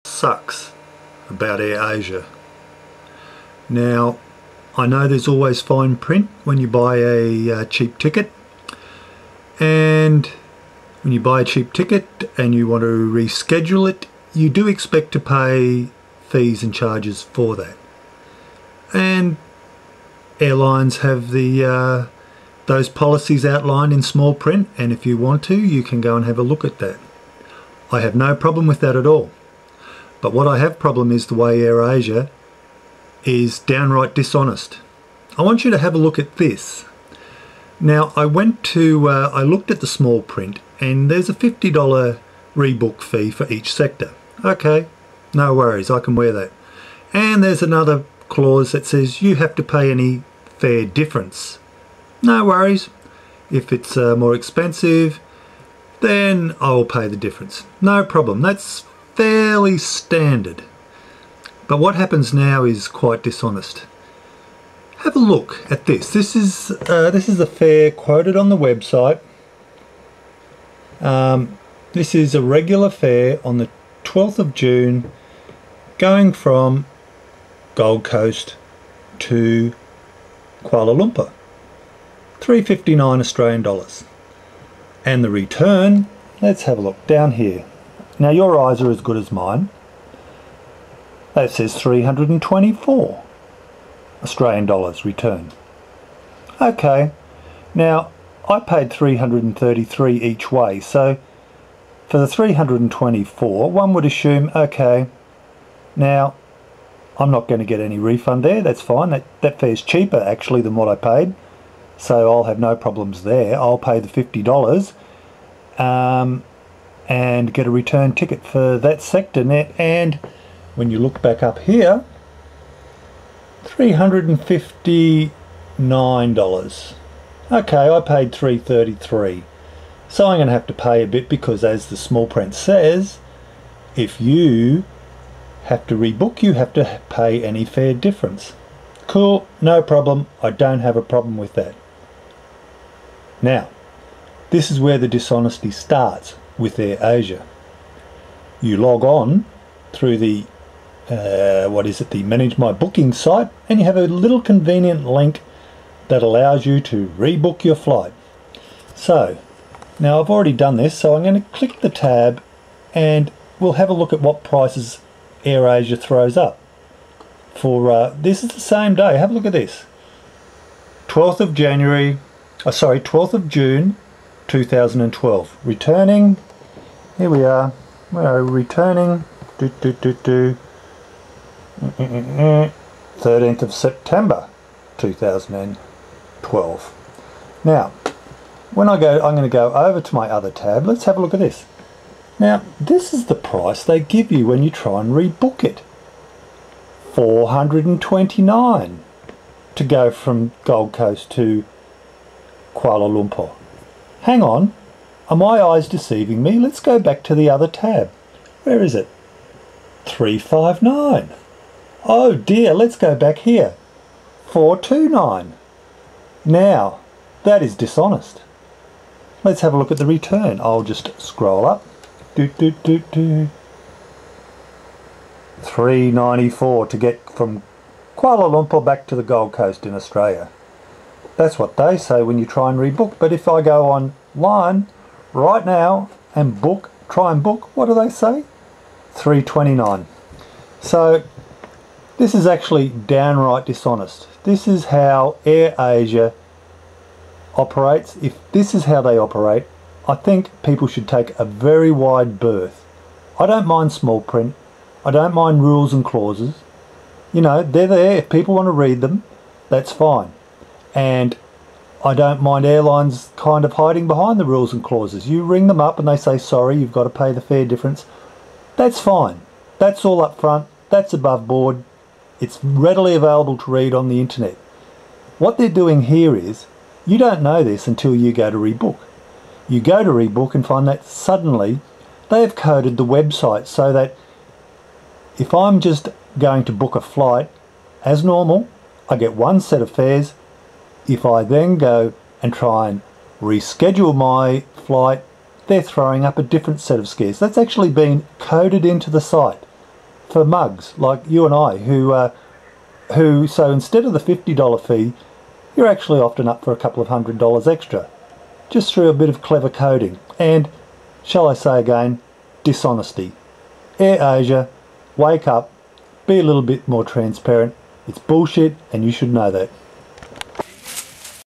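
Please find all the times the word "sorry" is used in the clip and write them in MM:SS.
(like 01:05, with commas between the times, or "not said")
02:52, 04:26.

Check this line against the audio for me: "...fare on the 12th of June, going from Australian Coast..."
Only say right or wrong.
wrong.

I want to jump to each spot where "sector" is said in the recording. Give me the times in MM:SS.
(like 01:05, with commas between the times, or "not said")
00:43, 01:59.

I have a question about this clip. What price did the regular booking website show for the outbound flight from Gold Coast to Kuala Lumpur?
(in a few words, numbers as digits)
359 Australian dollars.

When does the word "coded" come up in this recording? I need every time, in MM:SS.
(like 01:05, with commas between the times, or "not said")
04:42, 04:58.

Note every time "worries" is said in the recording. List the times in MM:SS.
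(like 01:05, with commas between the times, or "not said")
00:45, 00:52.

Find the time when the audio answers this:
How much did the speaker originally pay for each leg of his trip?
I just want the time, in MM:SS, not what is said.
01:38.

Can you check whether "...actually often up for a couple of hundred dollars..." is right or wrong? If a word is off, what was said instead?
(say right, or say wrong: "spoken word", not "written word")
right.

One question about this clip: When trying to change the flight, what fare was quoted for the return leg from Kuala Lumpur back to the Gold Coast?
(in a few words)
394.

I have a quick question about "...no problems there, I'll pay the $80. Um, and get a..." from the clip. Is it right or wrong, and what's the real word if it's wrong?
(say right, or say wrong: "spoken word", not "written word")
wrong: "50", not "80".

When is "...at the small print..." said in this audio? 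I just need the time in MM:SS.
00:39.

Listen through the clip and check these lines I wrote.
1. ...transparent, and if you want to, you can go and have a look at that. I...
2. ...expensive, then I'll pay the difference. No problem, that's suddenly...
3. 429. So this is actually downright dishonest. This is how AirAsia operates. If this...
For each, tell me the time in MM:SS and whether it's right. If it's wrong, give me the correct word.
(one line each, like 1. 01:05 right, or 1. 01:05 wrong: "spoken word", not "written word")
1. 00:24 wrong: "print", not "transparent"
2. 00:54 wrong: "fairly", not "suddenly"
3. 03:59 wrong: "329", not "429".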